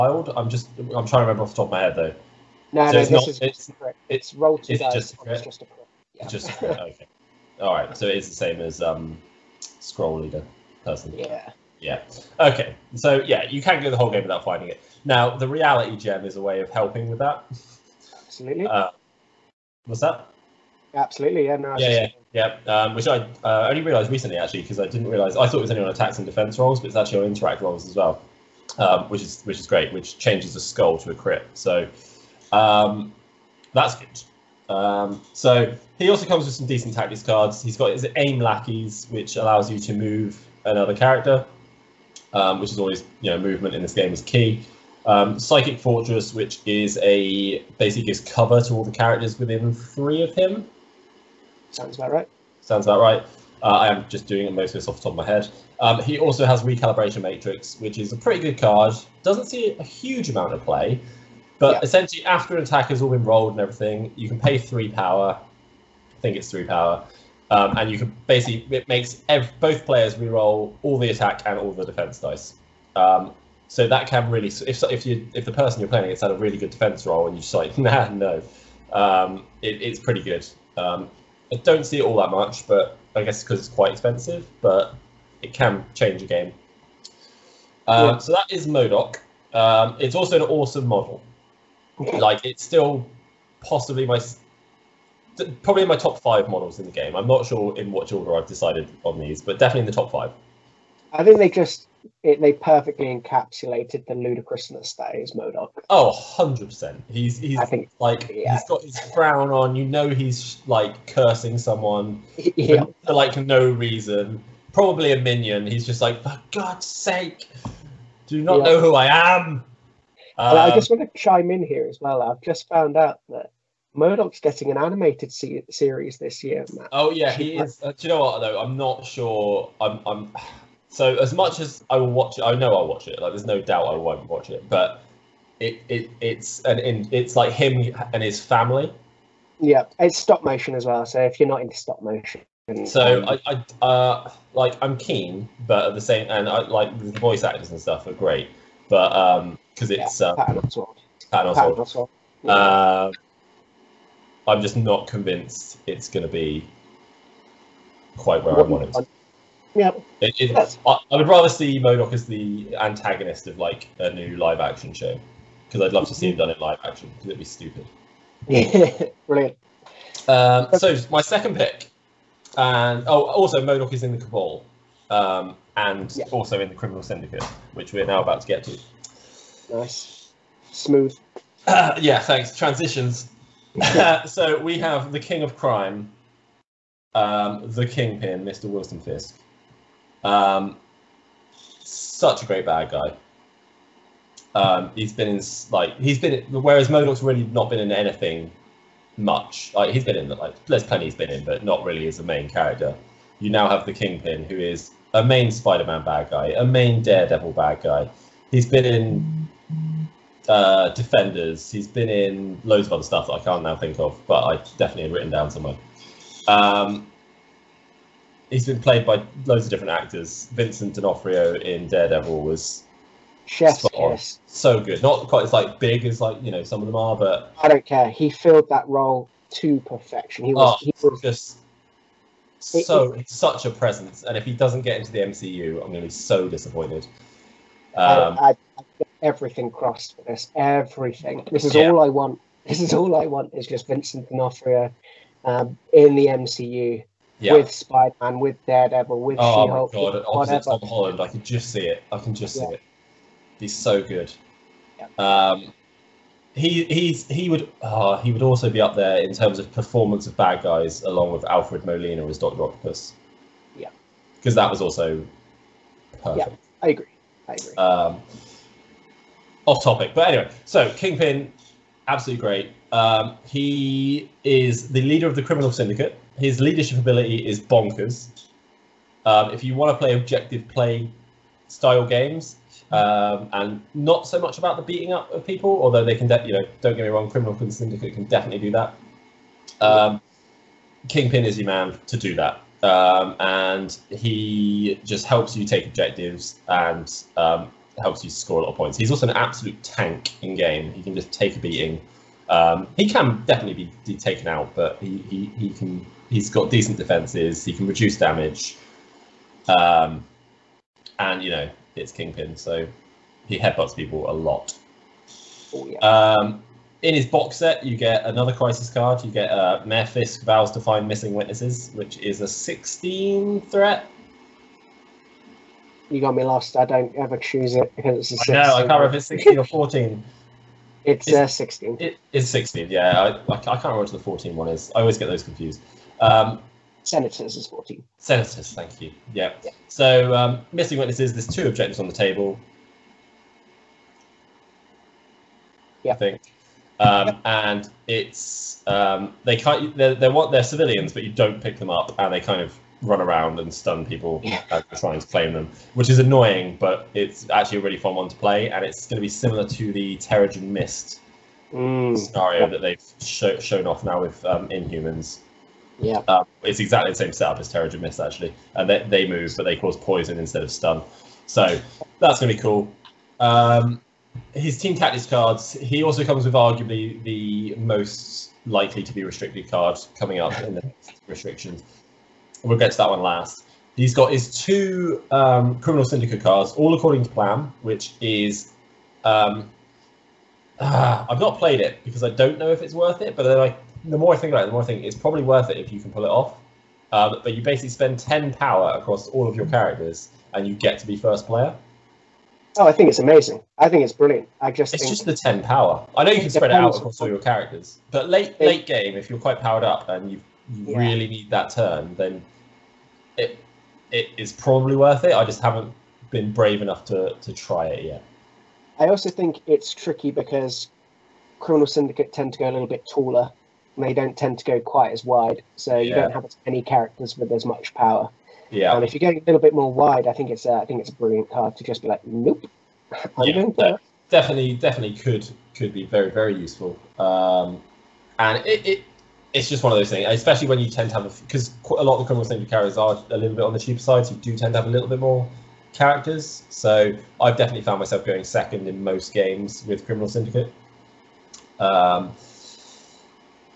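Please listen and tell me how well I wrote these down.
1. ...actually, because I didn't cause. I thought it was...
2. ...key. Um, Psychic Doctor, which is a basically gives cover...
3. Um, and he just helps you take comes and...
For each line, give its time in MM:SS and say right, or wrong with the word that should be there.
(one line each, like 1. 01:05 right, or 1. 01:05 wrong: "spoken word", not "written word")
1. 00:24 wrong: "realise", not "cause"
2. 00:44 wrong: "Fortress", not "Doctor"
3. 04:52 wrong: "objectives", not "comes".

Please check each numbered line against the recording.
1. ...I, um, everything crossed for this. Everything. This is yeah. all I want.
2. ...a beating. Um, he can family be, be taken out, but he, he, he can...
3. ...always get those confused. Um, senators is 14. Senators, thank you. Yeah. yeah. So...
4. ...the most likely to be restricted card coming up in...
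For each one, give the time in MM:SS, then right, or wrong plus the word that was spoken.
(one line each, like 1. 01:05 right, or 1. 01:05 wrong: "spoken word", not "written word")
1. 03:58 right
2. 05:01 wrong: "definitely", not "family"
3. 05:35 right
4. 06:17 right.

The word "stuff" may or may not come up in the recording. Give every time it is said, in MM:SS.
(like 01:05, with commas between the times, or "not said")
02:27, 03:33.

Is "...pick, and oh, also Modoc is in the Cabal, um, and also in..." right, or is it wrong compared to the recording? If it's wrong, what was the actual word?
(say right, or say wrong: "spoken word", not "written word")
right.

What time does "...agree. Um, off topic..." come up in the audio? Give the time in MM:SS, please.
04:27.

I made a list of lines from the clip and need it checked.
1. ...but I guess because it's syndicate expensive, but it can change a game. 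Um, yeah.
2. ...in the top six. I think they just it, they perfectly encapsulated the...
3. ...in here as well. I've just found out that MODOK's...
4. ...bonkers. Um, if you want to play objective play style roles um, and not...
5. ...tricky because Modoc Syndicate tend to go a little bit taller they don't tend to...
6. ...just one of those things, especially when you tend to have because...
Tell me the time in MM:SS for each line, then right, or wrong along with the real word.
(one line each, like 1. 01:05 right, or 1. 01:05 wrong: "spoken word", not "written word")
1. 01:22 wrong: "quite", not "syndicate"
2. 01:39 wrong: "five", not "six"
3. 02:01 right
4. 04:37 wrong: "games", not "roles"
5. 06:59 wrong: "Criminal", not "Modoc"
6. 07:19 right.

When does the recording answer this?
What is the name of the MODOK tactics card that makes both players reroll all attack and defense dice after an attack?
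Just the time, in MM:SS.
00:56.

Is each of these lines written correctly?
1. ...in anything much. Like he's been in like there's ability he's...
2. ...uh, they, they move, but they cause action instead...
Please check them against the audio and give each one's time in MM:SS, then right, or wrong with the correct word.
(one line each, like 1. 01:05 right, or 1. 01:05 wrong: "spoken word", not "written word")
1. 03:17 wrong: "plenty", not "ability"
2. 06:08 wrong: "poison", not "action".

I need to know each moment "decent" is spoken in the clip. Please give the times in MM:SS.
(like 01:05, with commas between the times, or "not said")
00:36, 05:06.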